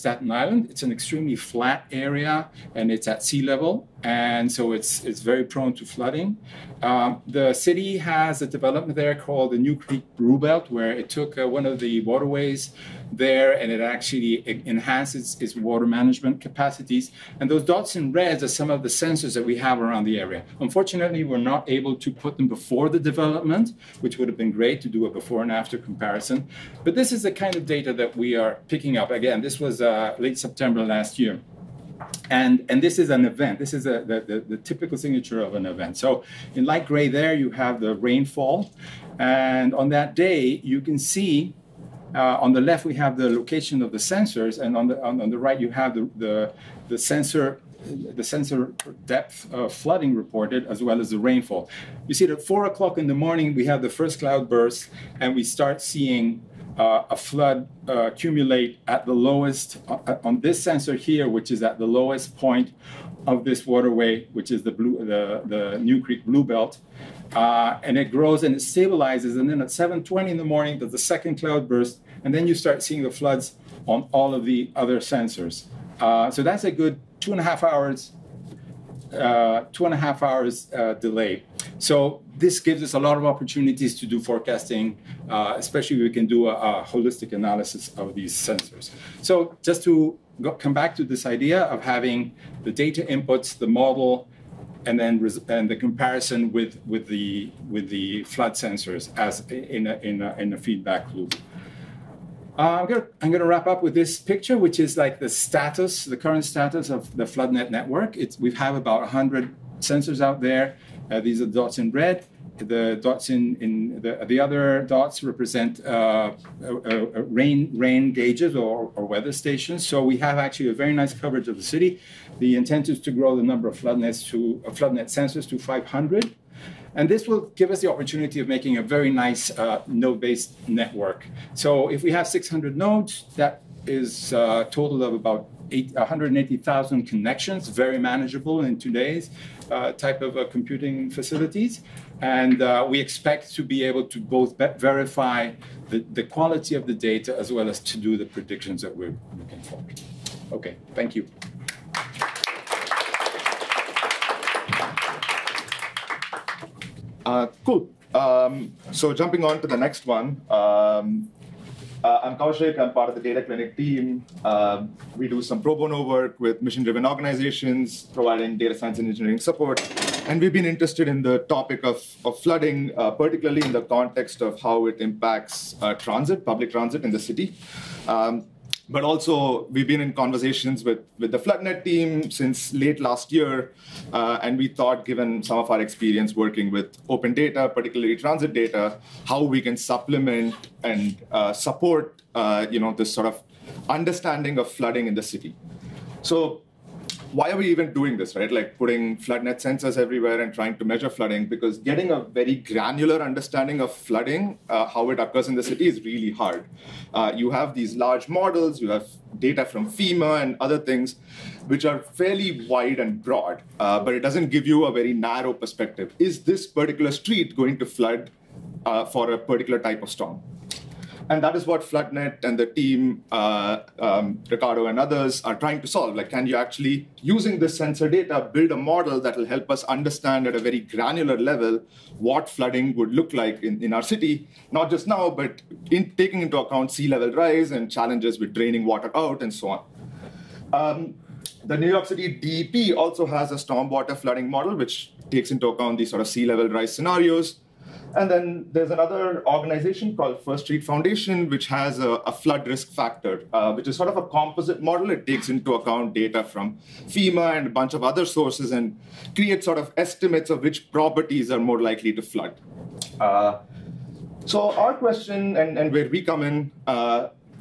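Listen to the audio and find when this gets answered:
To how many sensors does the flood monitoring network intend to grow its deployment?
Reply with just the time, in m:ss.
2:05.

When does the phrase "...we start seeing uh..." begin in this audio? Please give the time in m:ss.
0:55.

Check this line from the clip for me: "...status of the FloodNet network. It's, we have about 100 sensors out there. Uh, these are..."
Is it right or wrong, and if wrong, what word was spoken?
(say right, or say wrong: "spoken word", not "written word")
right.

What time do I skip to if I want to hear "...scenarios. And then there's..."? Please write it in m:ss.
4:06.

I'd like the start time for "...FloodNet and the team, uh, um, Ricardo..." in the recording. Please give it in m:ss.
3:41.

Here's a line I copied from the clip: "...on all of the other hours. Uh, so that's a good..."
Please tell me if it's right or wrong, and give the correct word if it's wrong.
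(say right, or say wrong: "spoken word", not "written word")
wrong: "sensors", not "hours".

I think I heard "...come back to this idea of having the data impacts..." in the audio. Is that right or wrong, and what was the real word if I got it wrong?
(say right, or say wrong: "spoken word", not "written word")
wrong: "inputs", not "impacts".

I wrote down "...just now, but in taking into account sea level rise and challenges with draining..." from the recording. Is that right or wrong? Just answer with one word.
right.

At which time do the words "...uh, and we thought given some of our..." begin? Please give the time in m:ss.
3:04.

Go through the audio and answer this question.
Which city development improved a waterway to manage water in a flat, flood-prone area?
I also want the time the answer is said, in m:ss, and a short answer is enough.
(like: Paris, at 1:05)
New Creek Bluebelt, at 0:09.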